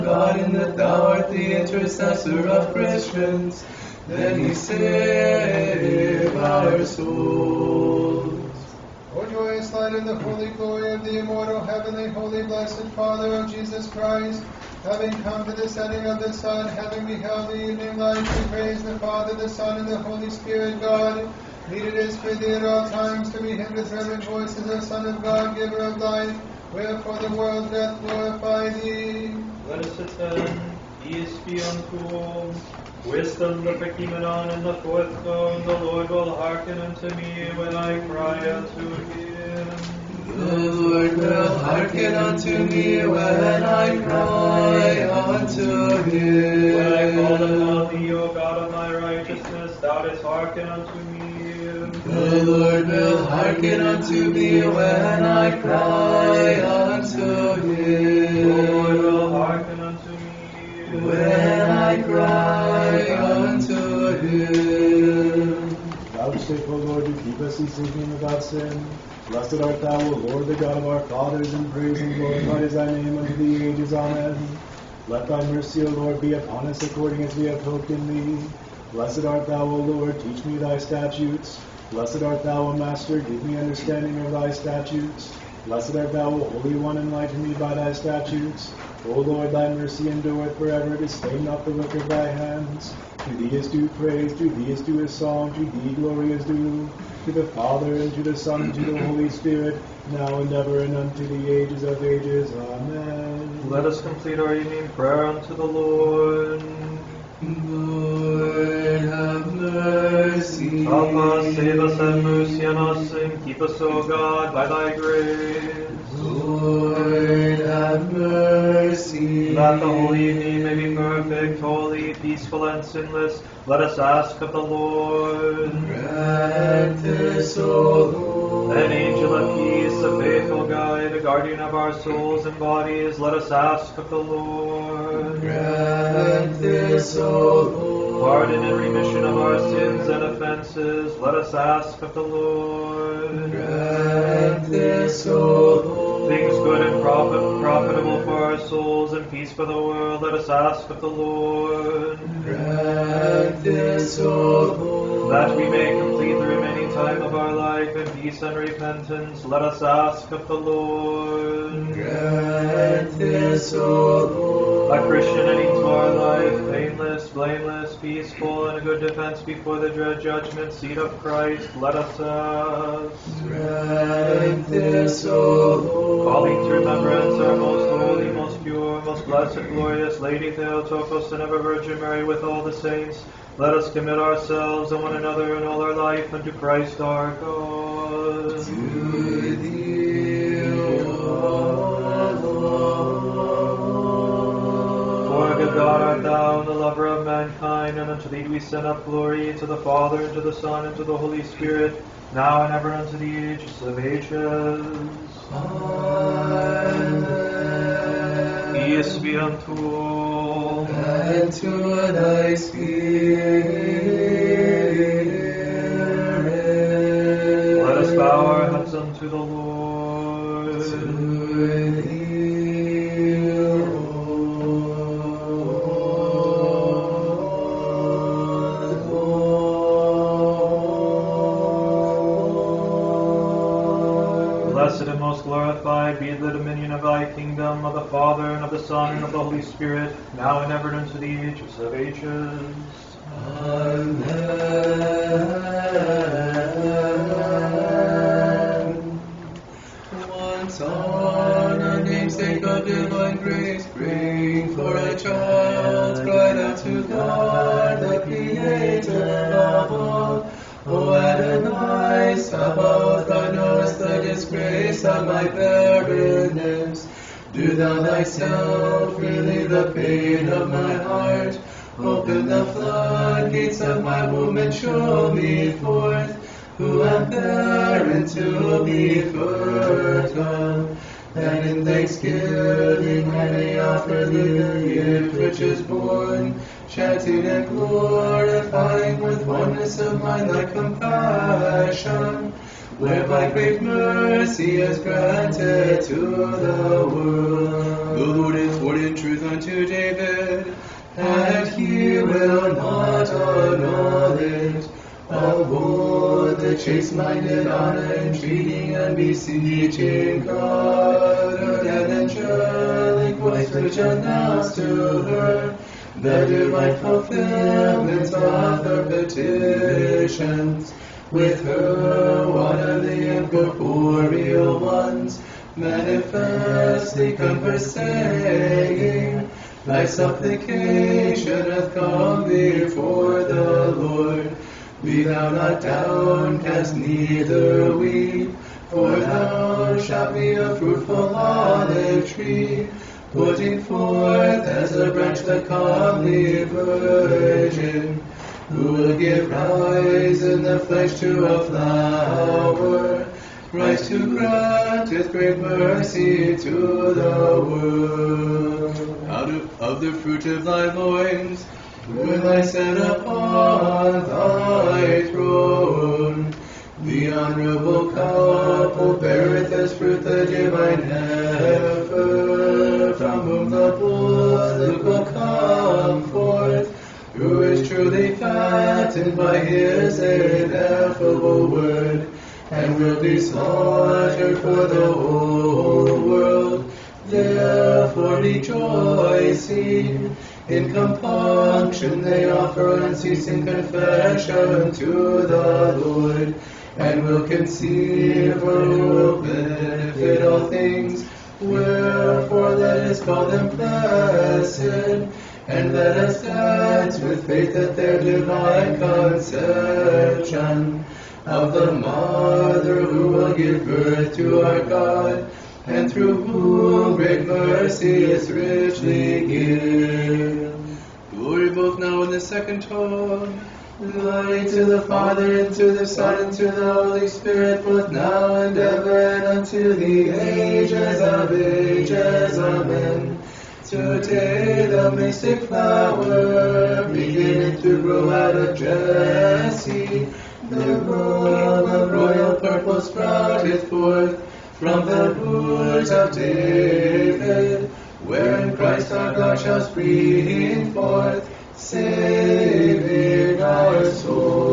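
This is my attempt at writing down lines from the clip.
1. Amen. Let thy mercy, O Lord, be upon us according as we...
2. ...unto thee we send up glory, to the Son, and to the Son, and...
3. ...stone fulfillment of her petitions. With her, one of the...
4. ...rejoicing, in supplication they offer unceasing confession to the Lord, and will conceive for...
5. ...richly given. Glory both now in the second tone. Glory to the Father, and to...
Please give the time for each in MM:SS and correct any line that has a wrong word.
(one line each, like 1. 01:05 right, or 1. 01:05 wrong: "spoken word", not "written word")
1. 01:13 right
2. 03:18 wrong: "Father", not "Son"
3. 05:16 wrong: "divine", not "stone"
4. 06:28 wrong: "compunction", not "supplication"
5. 06:58 right.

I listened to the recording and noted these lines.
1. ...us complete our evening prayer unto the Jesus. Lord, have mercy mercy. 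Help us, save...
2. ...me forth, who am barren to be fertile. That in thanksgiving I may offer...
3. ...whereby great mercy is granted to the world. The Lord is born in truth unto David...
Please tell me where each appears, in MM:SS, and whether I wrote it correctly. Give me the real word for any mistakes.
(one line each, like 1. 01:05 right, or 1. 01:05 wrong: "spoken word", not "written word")
1. 01:43 wrong: "Lord", not "Jesus"
2. 04:35 right
3. 04:52 right.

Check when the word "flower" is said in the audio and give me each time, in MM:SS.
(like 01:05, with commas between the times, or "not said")
05:51, 07:15.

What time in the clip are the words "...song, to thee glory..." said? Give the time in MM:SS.
01:35.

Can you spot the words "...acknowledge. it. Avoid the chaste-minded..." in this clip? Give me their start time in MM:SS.
05:03.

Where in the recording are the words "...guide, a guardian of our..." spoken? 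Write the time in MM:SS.
02:10.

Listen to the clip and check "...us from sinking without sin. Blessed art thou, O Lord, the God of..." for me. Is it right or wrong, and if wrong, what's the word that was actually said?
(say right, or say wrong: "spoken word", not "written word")
right.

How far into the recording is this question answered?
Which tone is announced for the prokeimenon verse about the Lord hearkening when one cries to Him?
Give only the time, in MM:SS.
00:34.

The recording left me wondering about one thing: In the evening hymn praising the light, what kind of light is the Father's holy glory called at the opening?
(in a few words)
joyous light.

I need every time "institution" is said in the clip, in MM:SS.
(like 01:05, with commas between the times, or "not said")
not said.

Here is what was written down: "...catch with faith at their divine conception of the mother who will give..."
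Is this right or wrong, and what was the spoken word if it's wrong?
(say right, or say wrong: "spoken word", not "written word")
right.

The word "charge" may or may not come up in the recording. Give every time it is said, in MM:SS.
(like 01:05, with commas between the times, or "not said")
not said.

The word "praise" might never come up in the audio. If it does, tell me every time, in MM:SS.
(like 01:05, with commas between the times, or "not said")
00:18, 01:11, 01:33.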